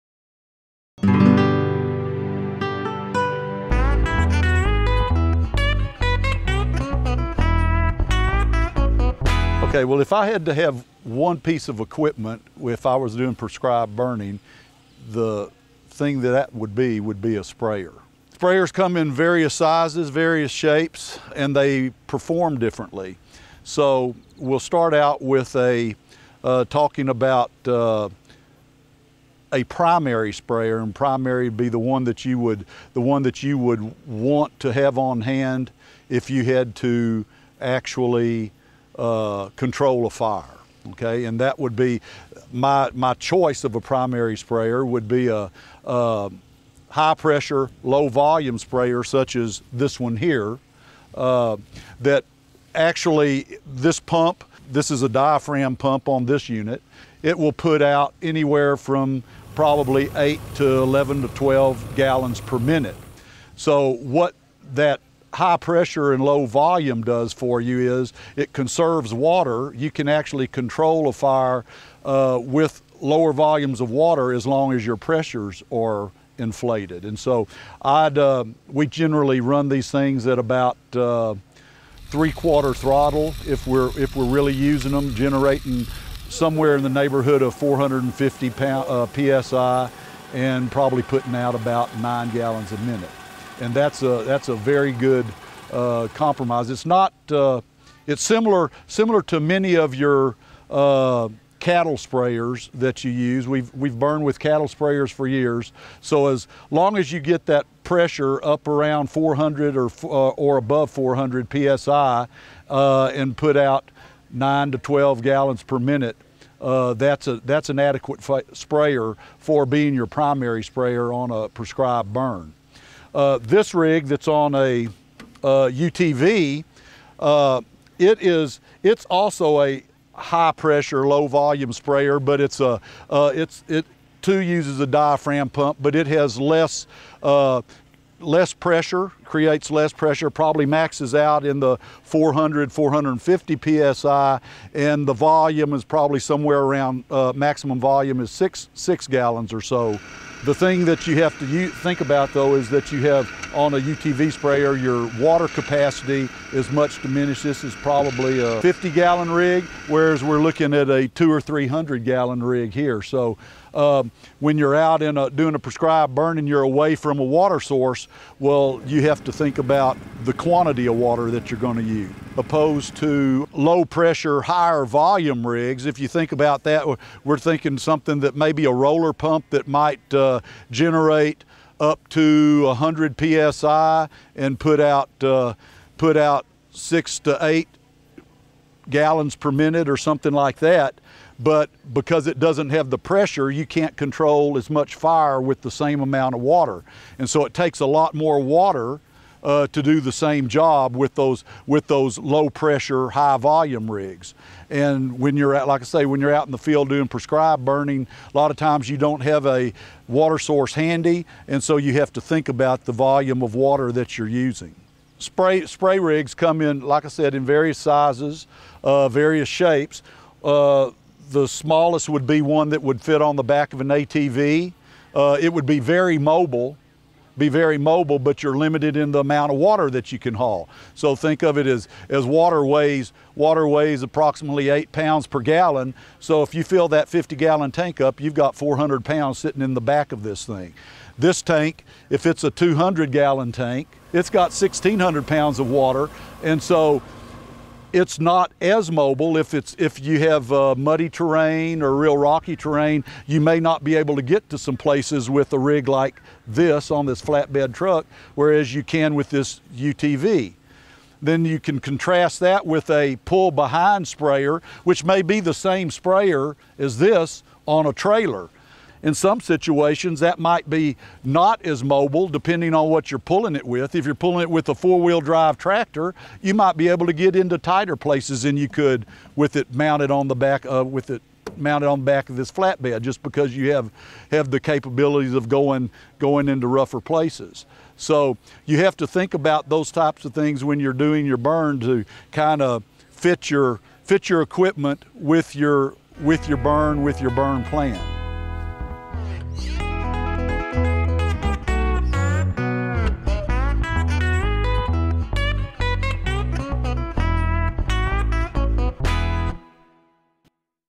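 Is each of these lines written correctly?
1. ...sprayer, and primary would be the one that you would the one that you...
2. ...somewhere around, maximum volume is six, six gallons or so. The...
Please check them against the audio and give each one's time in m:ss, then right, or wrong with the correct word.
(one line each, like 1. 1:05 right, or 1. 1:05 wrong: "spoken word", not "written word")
1. 0:30 right
2. 2:26 right.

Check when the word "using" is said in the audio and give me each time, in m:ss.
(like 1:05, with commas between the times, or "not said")
1:24, 3:34.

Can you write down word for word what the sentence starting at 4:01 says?
This tank, if it's a 200 gallon tank, it's got 1,600 pounds of water.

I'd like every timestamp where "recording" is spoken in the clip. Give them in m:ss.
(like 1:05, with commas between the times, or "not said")
not said.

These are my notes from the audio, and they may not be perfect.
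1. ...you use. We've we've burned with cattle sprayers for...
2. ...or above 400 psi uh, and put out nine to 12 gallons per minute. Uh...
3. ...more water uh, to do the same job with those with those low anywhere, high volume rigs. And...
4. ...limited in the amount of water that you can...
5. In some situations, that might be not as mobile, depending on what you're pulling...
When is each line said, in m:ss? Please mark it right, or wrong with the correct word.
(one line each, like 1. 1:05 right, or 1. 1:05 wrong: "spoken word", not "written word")
1. 1:43 right
2. 1:50 right
3. 3:18 wrong: "pressure", not "anywhere"
4. 3:48 right
5. 4:29 right.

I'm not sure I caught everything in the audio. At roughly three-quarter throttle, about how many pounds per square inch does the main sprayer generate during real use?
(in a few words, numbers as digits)
450.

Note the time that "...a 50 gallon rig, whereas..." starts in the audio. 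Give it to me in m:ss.
2:38.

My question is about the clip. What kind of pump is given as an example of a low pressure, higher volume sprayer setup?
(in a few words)
roller pump.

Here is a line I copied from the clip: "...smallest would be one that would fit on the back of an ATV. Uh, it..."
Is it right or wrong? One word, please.
right.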